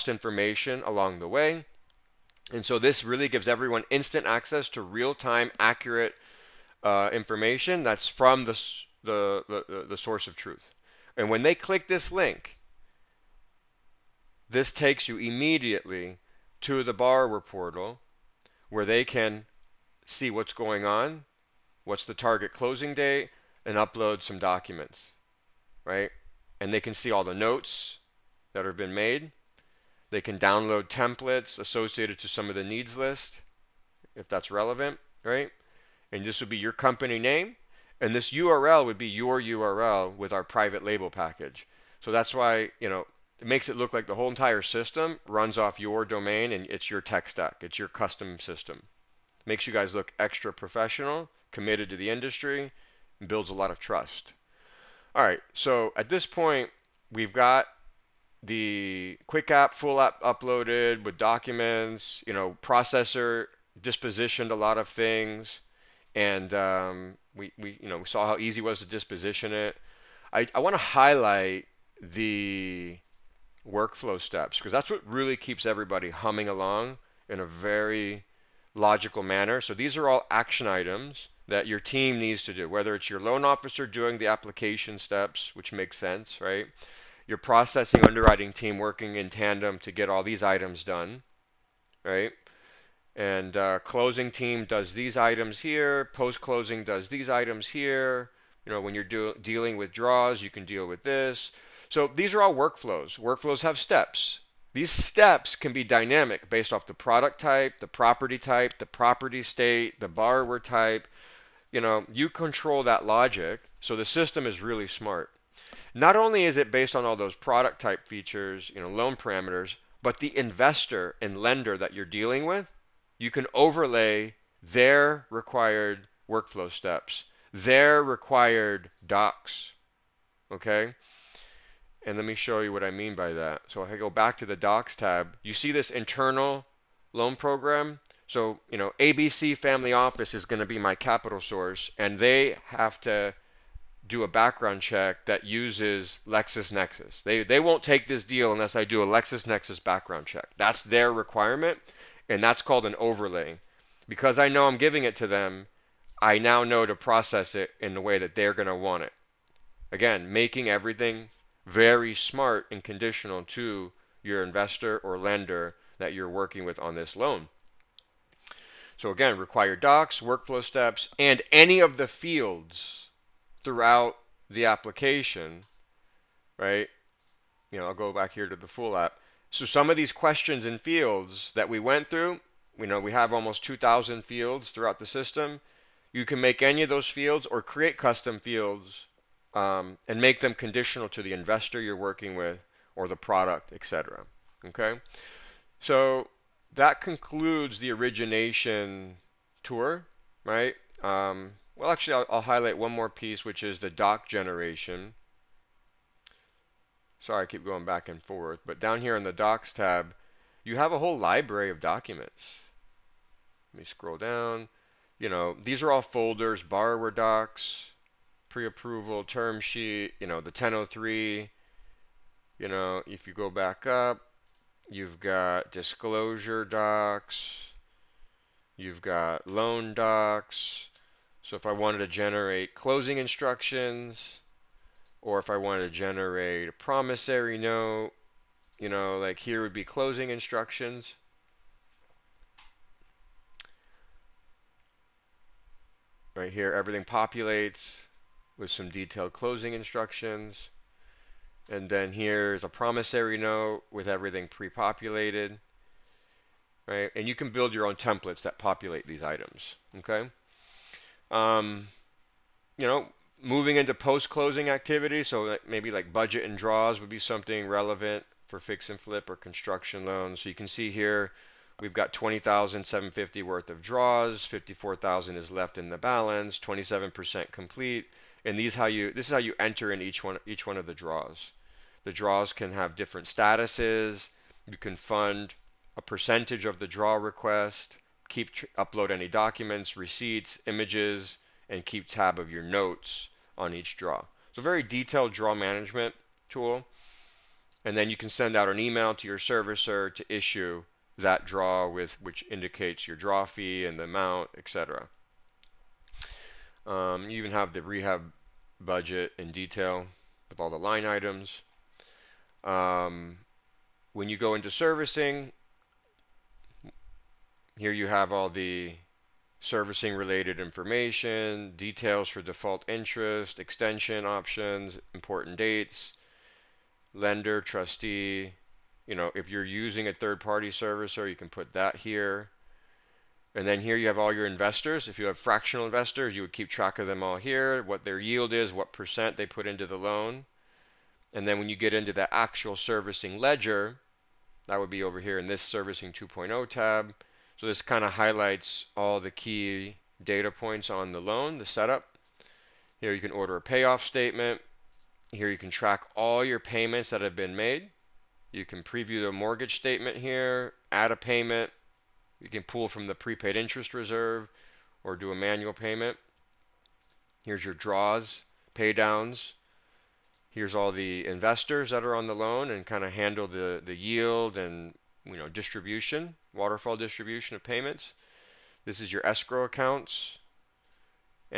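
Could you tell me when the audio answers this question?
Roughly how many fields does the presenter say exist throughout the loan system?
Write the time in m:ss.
3:03.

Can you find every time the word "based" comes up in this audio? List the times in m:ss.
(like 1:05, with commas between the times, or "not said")
1:46, 1:56.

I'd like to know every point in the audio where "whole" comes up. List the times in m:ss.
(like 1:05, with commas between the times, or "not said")
0:44, 3:30.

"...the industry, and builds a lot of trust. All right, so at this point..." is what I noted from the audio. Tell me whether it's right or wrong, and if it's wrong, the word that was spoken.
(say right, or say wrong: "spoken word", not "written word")
right.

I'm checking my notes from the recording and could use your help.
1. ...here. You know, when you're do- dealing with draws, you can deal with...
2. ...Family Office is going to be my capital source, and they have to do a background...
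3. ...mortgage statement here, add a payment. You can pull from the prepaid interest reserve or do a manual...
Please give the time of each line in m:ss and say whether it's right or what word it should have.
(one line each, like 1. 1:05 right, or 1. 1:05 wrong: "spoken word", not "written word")
1. 1:37 right
2. 2:19 right
3. 5:59 right.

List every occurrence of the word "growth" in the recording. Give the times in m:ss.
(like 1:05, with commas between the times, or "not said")
not said.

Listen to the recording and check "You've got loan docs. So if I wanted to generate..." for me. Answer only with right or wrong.
right.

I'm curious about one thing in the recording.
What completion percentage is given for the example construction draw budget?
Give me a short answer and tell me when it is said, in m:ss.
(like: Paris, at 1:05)
27%, at 4:36.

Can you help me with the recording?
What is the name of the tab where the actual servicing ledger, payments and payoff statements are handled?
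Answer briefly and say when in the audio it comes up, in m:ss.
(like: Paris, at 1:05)
servicing 2.0, at 5:45.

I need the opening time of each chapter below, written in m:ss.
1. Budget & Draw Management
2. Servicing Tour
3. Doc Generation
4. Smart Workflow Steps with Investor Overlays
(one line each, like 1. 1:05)
1. 4:24
2. 5:14
3. 3:25
4. 1:09.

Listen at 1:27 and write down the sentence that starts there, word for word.
Your processing underwriting team working in tandem to get all these items done, right?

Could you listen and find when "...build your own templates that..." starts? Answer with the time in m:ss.
4:17.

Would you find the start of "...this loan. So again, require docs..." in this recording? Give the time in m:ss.
2:46.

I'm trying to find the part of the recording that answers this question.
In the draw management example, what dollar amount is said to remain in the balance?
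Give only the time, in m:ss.
4:34.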